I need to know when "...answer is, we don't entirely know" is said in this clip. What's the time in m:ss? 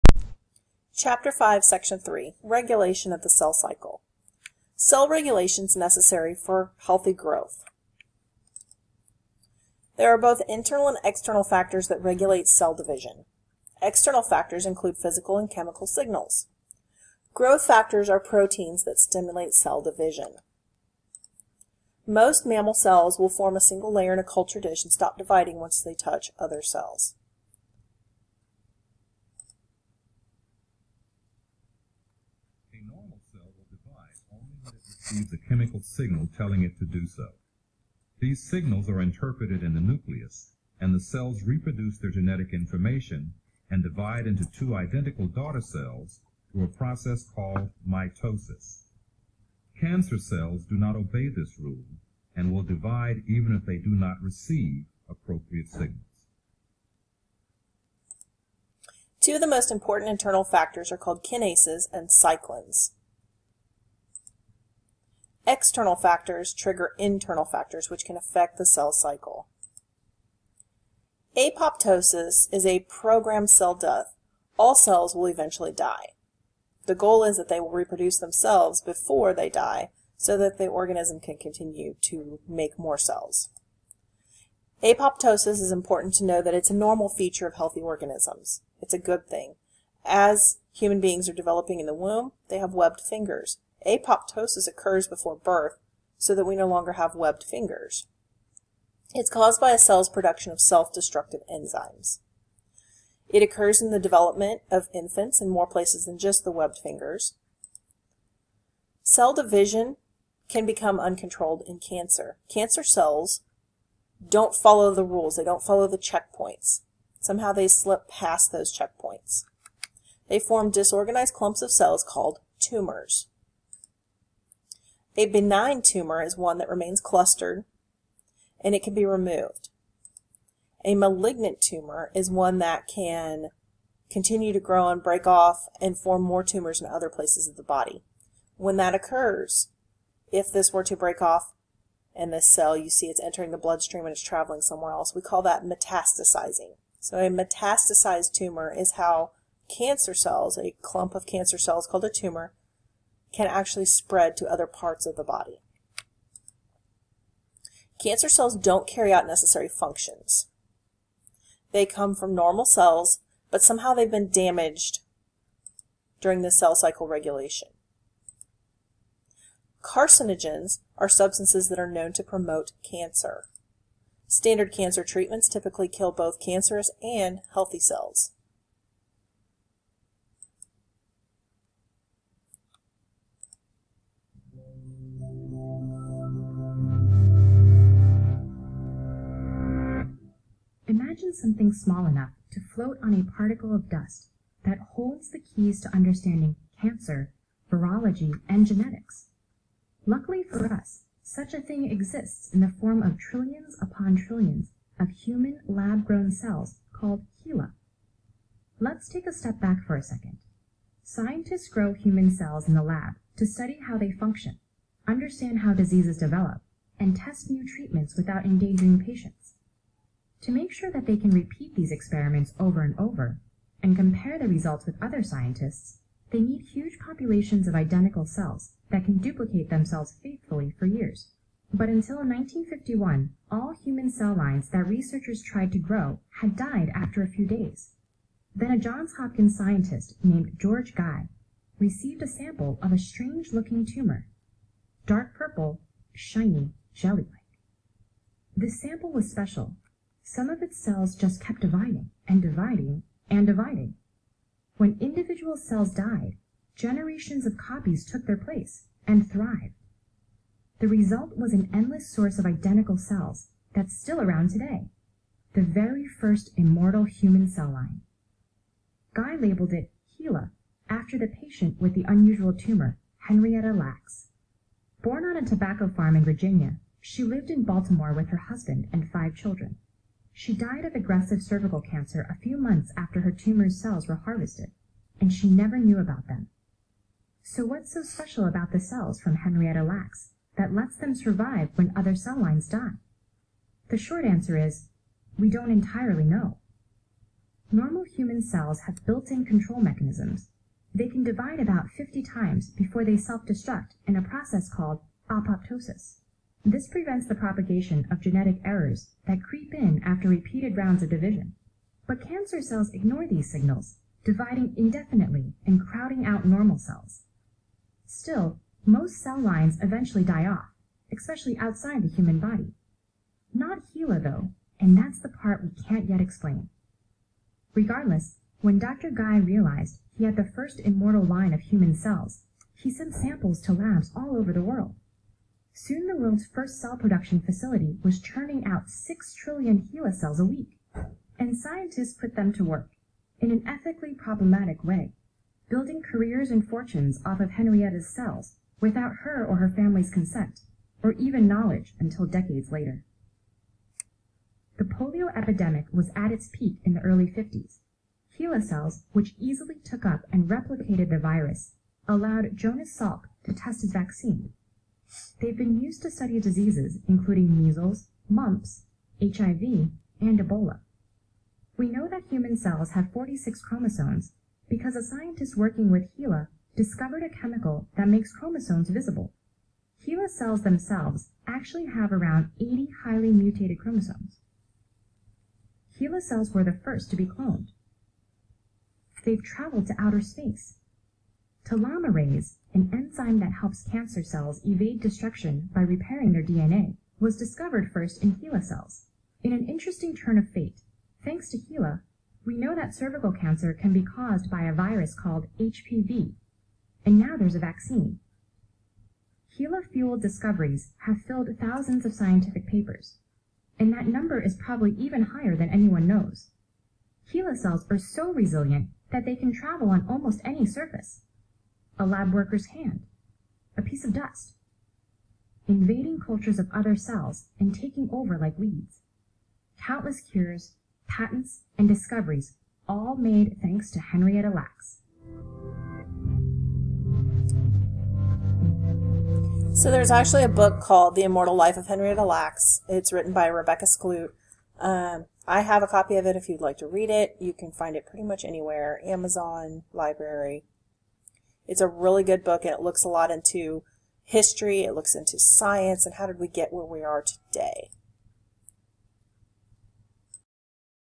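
4:54.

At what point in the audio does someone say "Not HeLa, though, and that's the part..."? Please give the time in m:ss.
5:23.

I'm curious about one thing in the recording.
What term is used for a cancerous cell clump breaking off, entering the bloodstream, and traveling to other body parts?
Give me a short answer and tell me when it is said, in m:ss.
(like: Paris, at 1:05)
metastasizing, at 2:25.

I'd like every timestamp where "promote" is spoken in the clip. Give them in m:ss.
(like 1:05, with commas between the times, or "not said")
2:52.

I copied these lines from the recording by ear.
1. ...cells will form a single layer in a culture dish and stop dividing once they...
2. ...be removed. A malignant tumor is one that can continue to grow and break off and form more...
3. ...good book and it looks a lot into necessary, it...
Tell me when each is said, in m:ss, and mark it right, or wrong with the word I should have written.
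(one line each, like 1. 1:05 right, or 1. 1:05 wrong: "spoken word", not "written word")
1. 0:22 right
2. 2:08 right
3. 7:32 wrong: "history", not "necessary".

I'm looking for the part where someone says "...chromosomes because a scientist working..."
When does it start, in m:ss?
6:13.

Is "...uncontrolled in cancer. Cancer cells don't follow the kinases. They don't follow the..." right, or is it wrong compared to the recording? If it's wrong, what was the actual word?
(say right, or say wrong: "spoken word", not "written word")
wrong: "rules", not "kinases".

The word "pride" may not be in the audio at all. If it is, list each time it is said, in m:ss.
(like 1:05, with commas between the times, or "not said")
not said.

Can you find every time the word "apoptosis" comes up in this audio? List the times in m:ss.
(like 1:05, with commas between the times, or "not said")
1:11, 1:24, 1:33, 5:05.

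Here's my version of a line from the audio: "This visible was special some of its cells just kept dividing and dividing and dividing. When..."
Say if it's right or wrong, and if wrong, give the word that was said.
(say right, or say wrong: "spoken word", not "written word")
wrong: "sample", not "visible".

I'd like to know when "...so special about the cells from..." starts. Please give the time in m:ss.
4:47.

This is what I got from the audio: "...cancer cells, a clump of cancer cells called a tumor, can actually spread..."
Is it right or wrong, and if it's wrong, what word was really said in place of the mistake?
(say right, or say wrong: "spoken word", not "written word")
right.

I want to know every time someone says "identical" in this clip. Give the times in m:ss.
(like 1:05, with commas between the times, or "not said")
0:44, 3:47, 4:22.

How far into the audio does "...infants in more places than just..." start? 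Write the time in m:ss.
1:44.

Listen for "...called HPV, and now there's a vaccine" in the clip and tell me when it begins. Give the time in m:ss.
6:45.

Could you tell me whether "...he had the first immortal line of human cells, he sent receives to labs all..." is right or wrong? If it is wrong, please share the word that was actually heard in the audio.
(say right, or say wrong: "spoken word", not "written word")
wrong: "samples", not "receives".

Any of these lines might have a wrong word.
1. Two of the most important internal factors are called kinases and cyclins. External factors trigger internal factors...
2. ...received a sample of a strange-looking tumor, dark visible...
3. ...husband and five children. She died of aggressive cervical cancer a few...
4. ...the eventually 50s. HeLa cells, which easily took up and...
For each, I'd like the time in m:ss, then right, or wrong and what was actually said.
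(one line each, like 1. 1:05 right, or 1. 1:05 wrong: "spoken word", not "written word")
1. 0:59 right
2. 4:01 wrong: "purple", not "visible"
3. 4:38 right
4. 5:56 wrong: "early", not "eventually".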